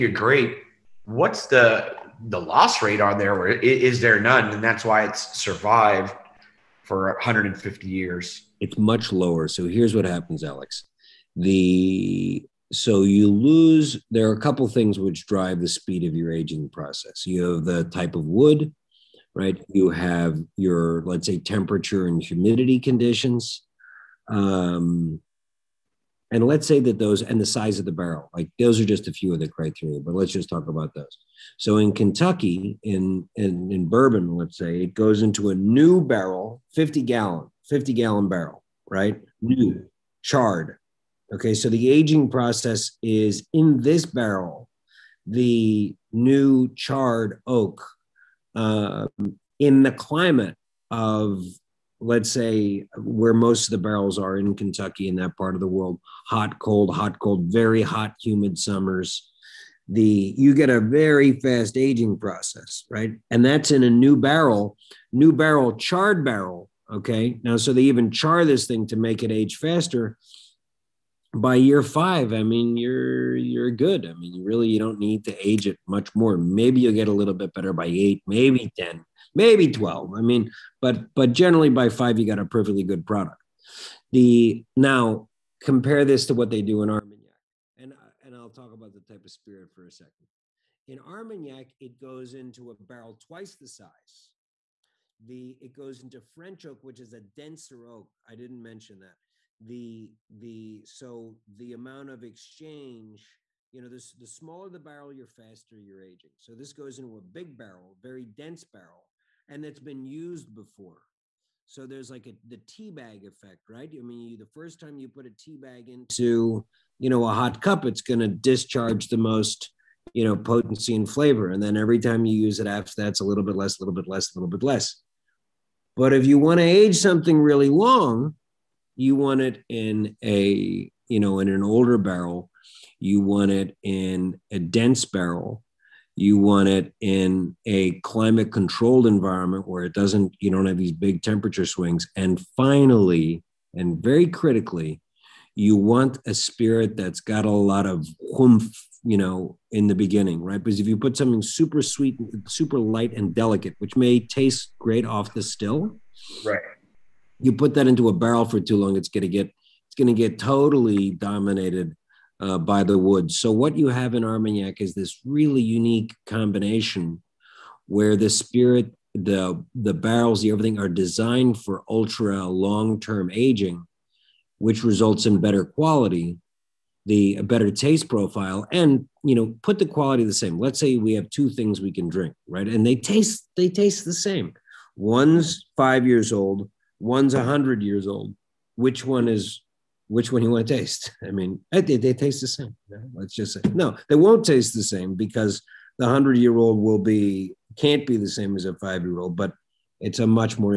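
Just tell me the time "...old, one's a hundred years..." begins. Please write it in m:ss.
3:06.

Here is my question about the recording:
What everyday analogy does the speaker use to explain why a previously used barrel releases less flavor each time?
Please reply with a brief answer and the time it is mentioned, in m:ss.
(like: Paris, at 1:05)
tea bag effect, at 1:52.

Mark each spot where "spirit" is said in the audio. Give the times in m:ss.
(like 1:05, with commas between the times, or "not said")
1:29, 2:26, 2:48.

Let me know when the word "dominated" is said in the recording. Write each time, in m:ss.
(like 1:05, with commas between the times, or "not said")
2:41.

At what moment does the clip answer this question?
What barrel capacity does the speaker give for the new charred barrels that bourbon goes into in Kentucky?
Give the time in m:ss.
0:37.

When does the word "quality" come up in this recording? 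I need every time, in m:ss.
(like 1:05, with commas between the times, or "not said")
2:55, 2:59.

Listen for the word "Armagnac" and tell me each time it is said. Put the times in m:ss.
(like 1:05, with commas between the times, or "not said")
1:26, 1:30, 2:44.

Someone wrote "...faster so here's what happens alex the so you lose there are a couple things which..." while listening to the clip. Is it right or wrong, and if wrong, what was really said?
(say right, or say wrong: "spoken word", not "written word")
wrong: "lower", not "faster".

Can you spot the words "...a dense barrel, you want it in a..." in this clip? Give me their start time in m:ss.
2:14.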